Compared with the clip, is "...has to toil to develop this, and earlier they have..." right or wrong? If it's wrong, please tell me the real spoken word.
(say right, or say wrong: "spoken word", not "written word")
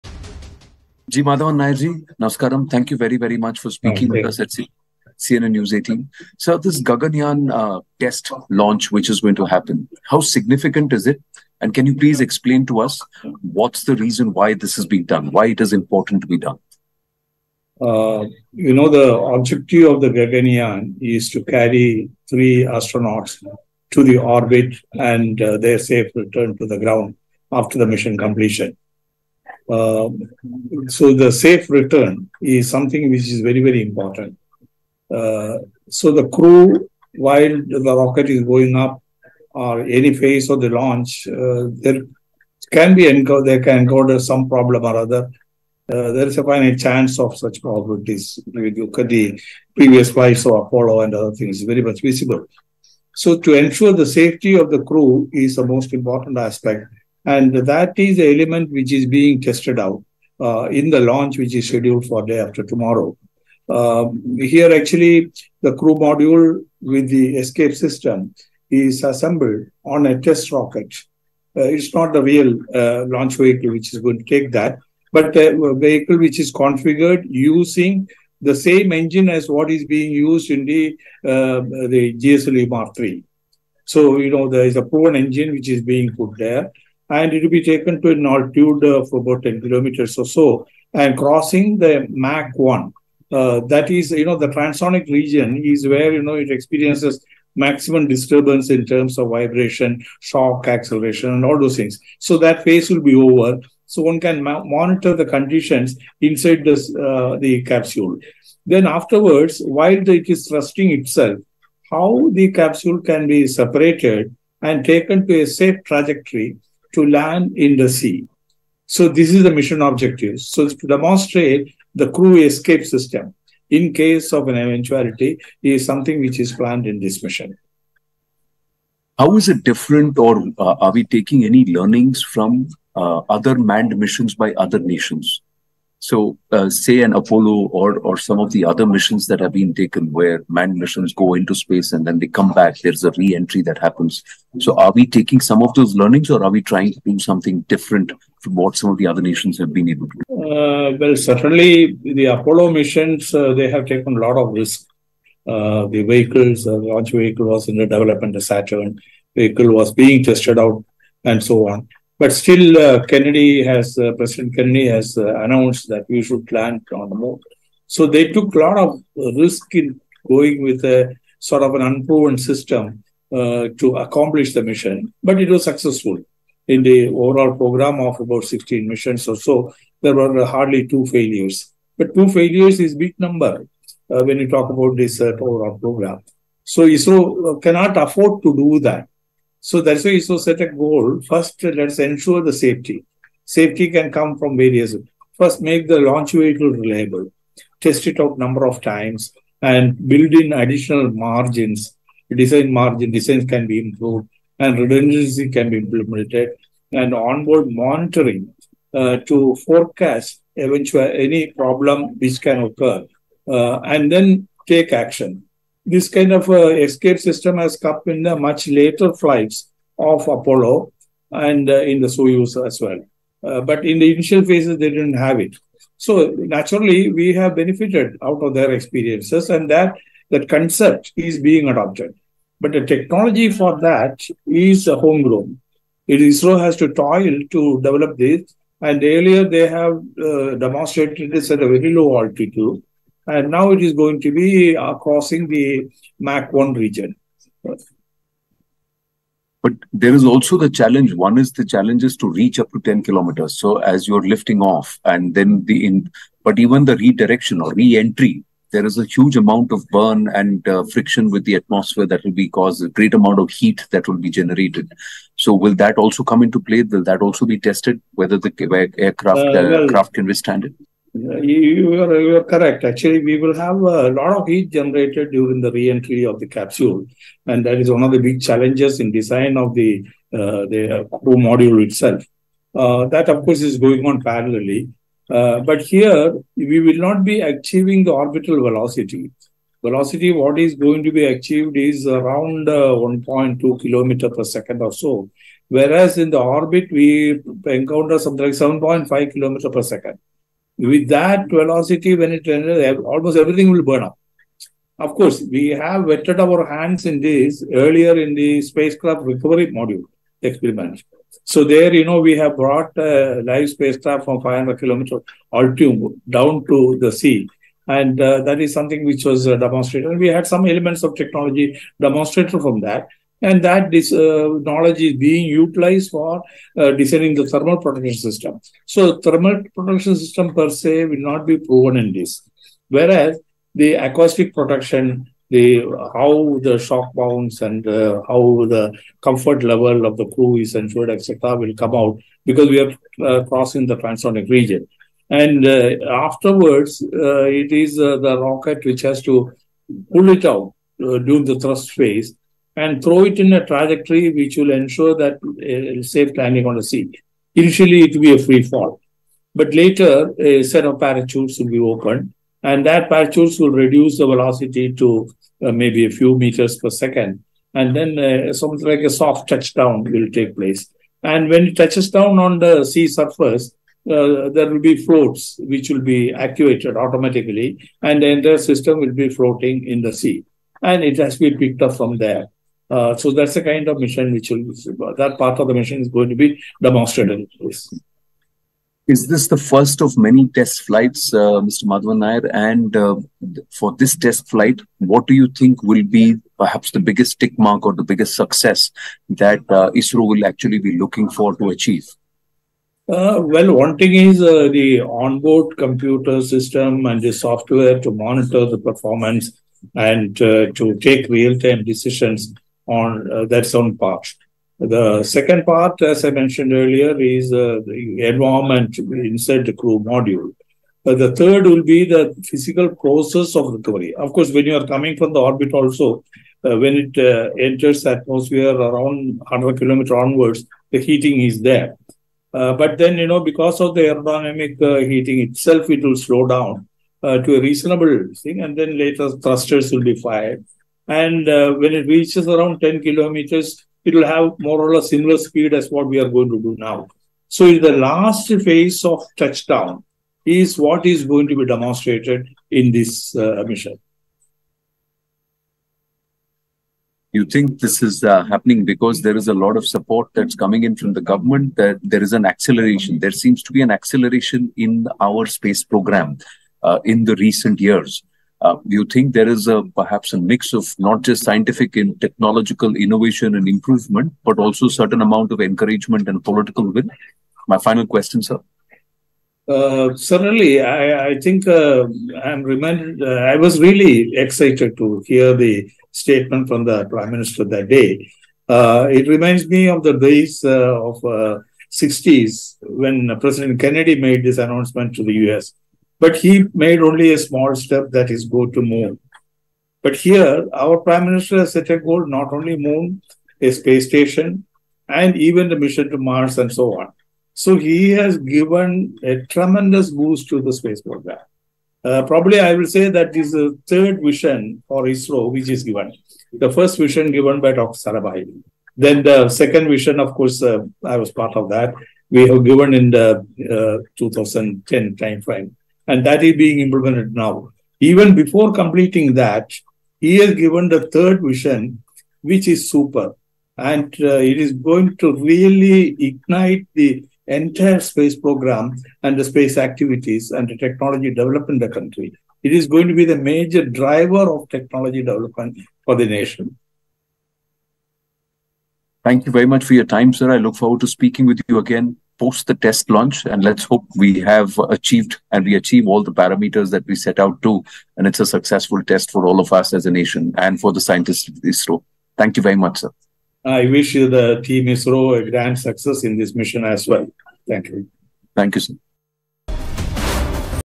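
right.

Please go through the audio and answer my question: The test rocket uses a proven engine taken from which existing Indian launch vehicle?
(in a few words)
GSLV Mark III.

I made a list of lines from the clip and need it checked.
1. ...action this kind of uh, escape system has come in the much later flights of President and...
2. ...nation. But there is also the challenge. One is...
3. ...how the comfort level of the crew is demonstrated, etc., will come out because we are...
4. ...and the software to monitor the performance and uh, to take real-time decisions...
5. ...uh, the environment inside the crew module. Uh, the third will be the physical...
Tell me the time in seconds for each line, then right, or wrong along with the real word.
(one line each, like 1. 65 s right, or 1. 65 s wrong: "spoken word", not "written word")
1. 214 s wrong: "Apollo", not "President"
2. 246 s wrong: "region", not "nation"
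3. 338 s wrong: "ensured", not "demonstrated"
4. 407 s right
5. 417 s right.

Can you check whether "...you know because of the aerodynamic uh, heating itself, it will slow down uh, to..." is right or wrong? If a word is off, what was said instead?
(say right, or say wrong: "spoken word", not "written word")
right.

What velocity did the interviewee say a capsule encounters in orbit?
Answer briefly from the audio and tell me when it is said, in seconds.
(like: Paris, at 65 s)
7.5 km per second, at 298 s.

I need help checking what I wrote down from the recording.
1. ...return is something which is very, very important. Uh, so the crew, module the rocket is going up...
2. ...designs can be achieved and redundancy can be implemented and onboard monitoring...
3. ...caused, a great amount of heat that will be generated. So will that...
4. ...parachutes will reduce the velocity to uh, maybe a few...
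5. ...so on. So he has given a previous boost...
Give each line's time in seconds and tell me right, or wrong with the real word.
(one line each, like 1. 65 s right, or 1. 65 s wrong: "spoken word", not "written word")
1. 31 s wrong: "while", not "module"
2. 203 s wrong: "improved", not "achieved"
3. 262 s right
4. 363 s right
5. 506 s wrong: "tremendous", not "previous".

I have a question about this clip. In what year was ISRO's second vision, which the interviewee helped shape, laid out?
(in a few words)
2010.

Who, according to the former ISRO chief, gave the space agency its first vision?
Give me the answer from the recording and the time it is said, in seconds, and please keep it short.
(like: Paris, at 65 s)
Dr. Sarabhai, at 517 s.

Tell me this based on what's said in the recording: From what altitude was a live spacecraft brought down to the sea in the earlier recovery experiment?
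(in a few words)
500 kilometers.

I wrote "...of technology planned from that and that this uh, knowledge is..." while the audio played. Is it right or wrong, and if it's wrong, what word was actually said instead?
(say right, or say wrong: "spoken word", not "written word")
wrong: "demonstrated", not "planned".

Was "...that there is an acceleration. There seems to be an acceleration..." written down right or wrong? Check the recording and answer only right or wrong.
right.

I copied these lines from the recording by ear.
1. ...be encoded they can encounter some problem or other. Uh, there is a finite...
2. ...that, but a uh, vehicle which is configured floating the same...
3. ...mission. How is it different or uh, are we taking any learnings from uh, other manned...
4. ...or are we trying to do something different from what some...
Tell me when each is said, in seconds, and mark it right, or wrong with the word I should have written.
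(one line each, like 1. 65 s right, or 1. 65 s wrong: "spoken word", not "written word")
1. 42 s right
2. 74 s wrong: "using", not "floating"
3. 127 s right
4. 146 s right.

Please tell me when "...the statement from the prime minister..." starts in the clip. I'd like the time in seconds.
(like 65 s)
485 s.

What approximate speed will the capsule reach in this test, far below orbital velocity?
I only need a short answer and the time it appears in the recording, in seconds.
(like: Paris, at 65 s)
1.2 km per second, at 292 s.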